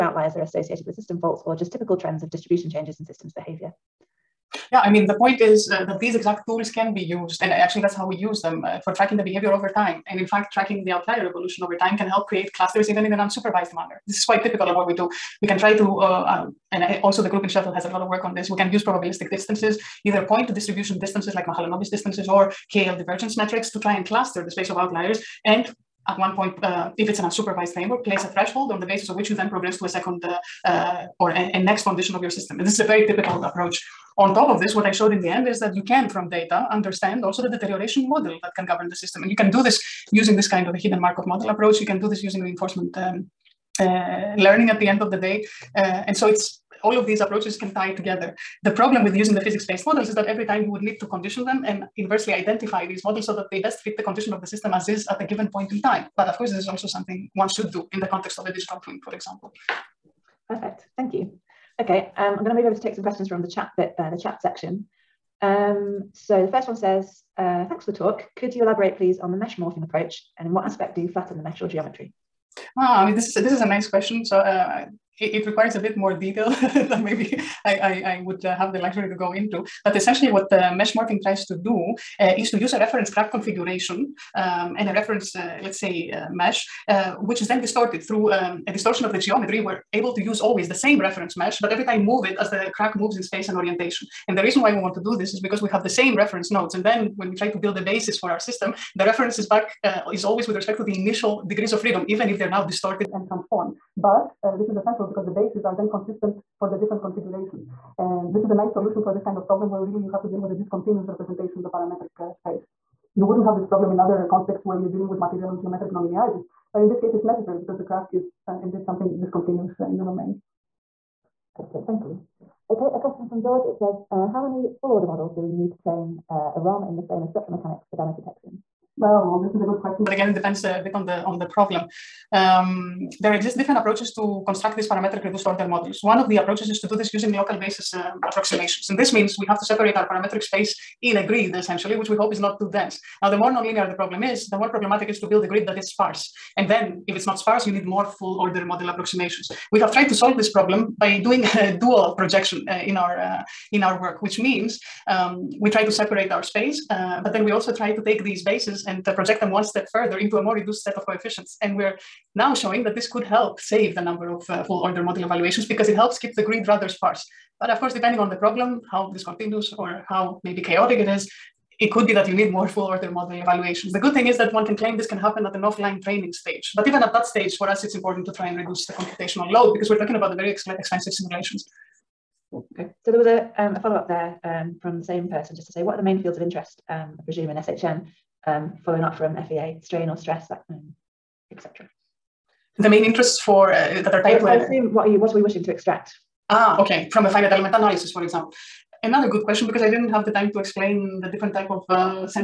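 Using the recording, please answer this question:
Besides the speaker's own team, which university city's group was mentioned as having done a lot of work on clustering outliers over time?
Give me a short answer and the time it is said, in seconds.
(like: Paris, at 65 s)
Sheffield, at 17 s.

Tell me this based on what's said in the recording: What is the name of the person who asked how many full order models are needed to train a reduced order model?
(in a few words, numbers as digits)
George.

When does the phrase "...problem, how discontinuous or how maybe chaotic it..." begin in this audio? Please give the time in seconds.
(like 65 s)
168 s.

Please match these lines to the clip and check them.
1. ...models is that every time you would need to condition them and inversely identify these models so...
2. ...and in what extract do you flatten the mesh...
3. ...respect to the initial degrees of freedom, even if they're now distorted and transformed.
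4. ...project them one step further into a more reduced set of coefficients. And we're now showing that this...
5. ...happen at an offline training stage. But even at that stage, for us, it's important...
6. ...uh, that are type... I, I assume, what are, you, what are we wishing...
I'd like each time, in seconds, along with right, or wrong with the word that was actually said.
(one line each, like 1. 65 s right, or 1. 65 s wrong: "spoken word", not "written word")
1. 49 s right
2. 70 s wrong: "aspect", not "extract"
3. 100 s right
4. 159 s right
5. 175 s right
6. 193 s right.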